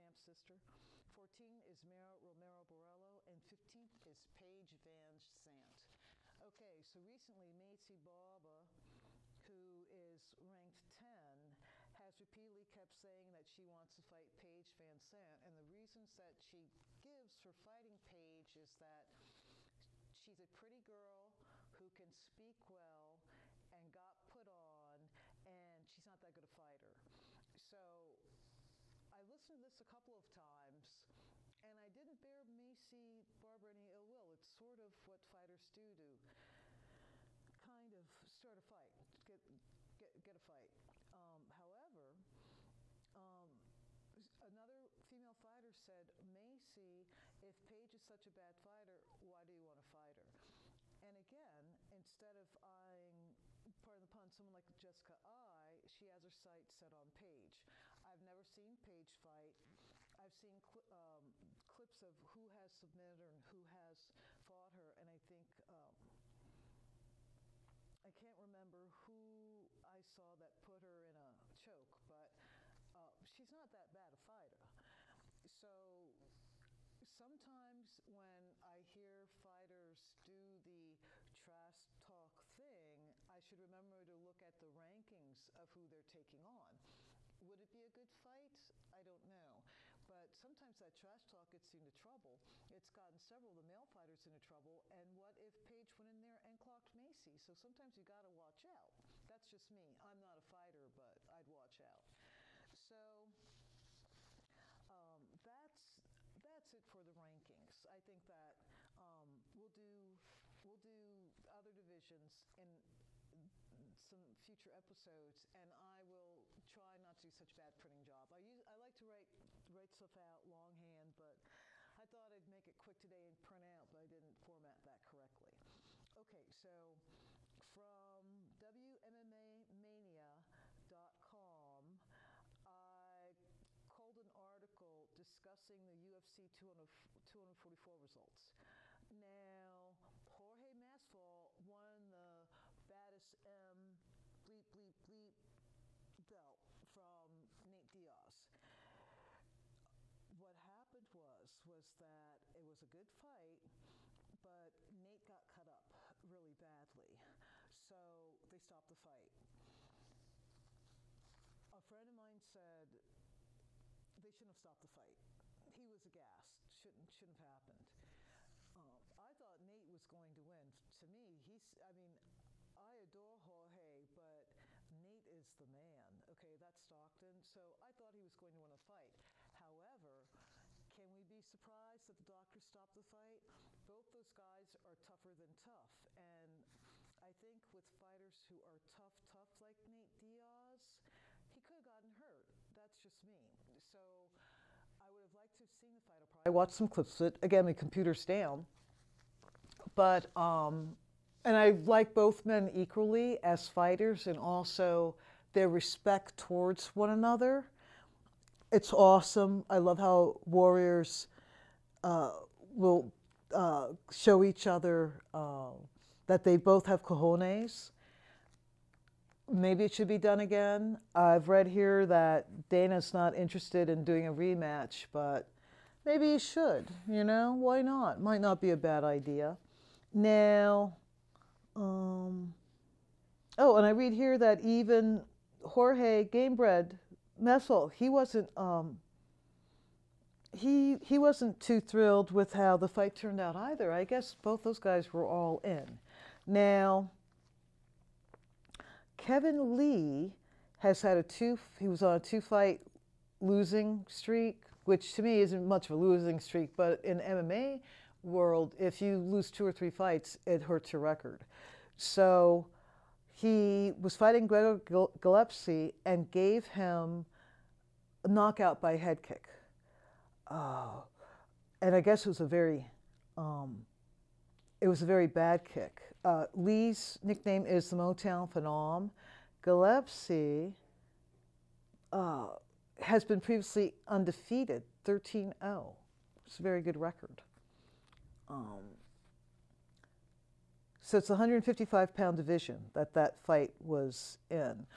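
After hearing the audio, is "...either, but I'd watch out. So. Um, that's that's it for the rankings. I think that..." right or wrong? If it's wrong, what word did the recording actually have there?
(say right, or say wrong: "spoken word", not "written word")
wrong: "fighter", not "either".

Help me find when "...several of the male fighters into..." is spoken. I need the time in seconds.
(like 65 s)
93 s.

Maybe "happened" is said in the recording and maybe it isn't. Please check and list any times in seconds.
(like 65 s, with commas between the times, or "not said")
150 s, 167 s.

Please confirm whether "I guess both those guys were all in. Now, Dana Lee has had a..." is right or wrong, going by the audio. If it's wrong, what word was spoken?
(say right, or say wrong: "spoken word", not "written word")
wrong: "Kevin", not "Dana".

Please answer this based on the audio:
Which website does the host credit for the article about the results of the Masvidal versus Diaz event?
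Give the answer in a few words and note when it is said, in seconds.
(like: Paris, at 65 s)
WMMAmania.com, at 128 s.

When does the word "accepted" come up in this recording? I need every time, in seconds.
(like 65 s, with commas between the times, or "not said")
not said.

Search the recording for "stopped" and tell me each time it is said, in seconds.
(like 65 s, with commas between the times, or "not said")
158 s, 164 s, 182 s.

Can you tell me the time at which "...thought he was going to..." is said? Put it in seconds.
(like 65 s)
177 s.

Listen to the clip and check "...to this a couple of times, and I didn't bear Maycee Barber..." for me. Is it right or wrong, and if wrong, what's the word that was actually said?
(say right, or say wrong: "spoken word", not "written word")
right.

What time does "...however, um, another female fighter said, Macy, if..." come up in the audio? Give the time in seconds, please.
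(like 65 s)
41 s.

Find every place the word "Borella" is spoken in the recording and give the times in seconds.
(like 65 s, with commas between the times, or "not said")
2 s.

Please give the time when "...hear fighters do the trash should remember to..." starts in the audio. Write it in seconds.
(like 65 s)
78 s.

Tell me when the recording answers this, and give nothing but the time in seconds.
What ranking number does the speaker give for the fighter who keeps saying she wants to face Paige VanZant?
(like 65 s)
10 s.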